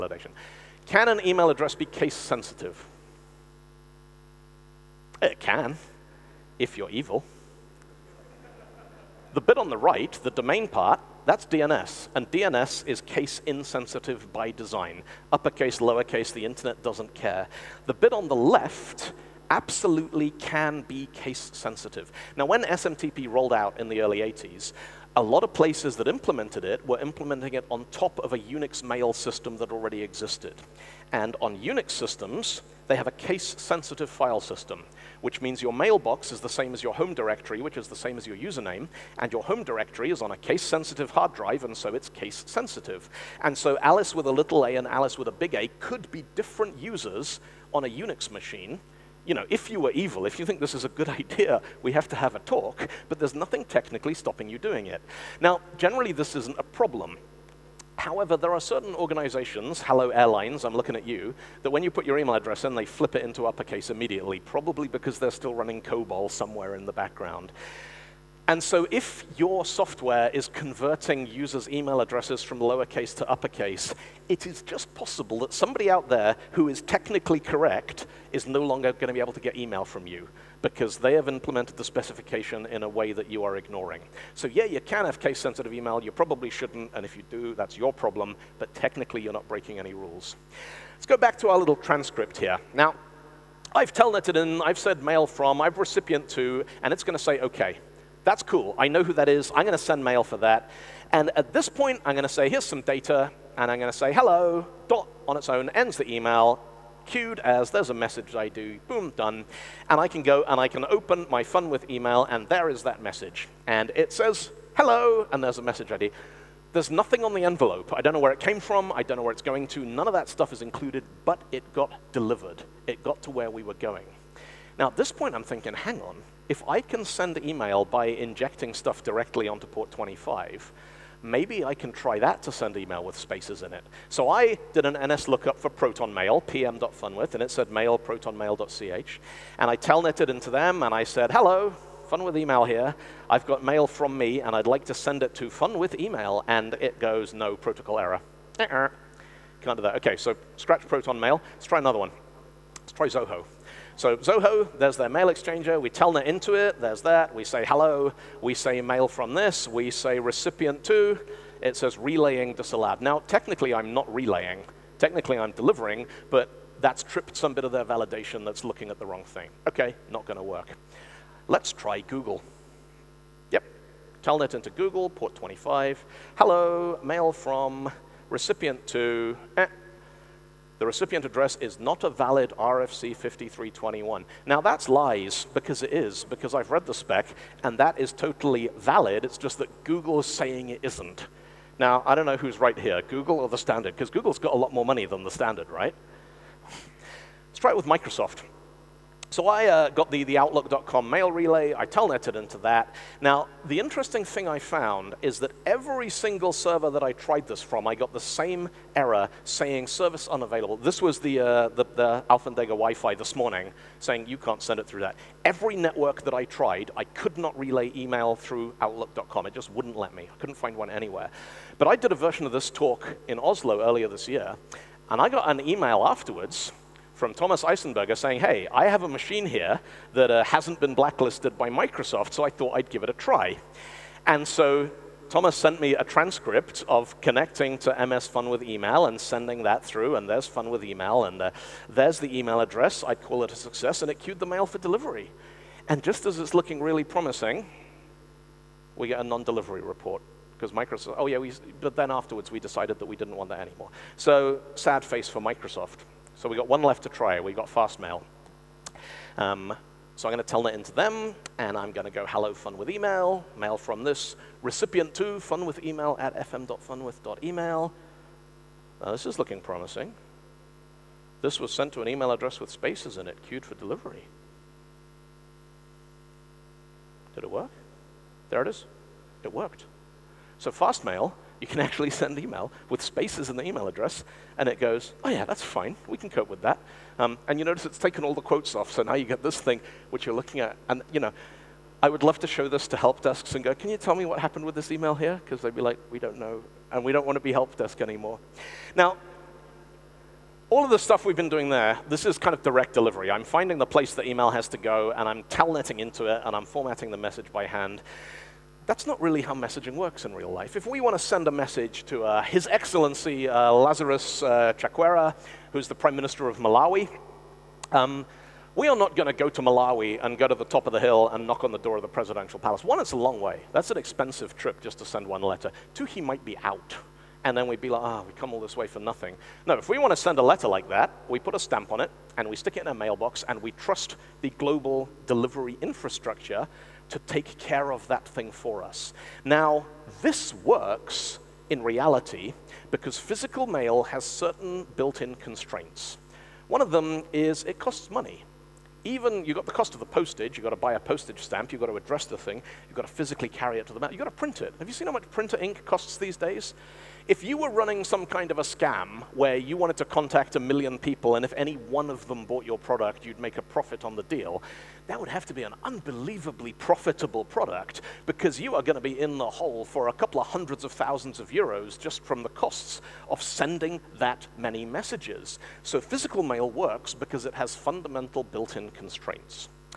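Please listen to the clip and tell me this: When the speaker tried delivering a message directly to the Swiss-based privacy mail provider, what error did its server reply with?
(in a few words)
protocol error.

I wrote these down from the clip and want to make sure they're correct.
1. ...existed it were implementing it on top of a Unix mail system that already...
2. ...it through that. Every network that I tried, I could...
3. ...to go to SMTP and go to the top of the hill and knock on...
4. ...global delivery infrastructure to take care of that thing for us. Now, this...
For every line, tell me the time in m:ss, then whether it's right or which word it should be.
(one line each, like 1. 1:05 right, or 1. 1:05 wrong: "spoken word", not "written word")
1. 0:26 wrong: "implemented", not "existed"
2. 3:34 right
3. 5:19 wrong: "Malawi", not "SMTP"
4. 5:34 right.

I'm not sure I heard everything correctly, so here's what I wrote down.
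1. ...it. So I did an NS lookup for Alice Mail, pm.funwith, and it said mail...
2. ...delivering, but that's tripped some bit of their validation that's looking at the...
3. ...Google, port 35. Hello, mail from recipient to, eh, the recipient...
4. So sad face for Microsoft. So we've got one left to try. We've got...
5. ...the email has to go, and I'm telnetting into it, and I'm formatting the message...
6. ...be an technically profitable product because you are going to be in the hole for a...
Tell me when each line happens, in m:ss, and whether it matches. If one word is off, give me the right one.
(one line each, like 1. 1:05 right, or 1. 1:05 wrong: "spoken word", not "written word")
1. 2:13 wrong: "Proton", not "Alice"
2. 2:45 right
3. 2:54 wrong: "25", not "35"
4. 4:14 right
5. 5:04 right
6. 6:05 wrong: "unbelievably", not "technically".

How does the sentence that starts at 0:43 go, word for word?
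And so Alice with a little a and Alice with a big A could be different users on a Unix machine.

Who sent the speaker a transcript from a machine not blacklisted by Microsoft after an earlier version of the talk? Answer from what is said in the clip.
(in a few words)
Thomas Eisenberger.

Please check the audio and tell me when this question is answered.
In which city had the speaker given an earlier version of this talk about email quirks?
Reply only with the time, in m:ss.
3:43.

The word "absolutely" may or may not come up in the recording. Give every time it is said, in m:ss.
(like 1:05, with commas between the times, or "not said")
0:19.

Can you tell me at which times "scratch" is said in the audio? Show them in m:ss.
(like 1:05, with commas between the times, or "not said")
2:30.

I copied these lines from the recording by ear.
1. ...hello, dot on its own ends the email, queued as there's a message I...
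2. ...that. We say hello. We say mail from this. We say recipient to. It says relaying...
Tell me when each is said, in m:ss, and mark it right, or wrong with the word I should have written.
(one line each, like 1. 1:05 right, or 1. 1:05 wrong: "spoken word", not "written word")
1. 1:44 right
2. 2:37 right.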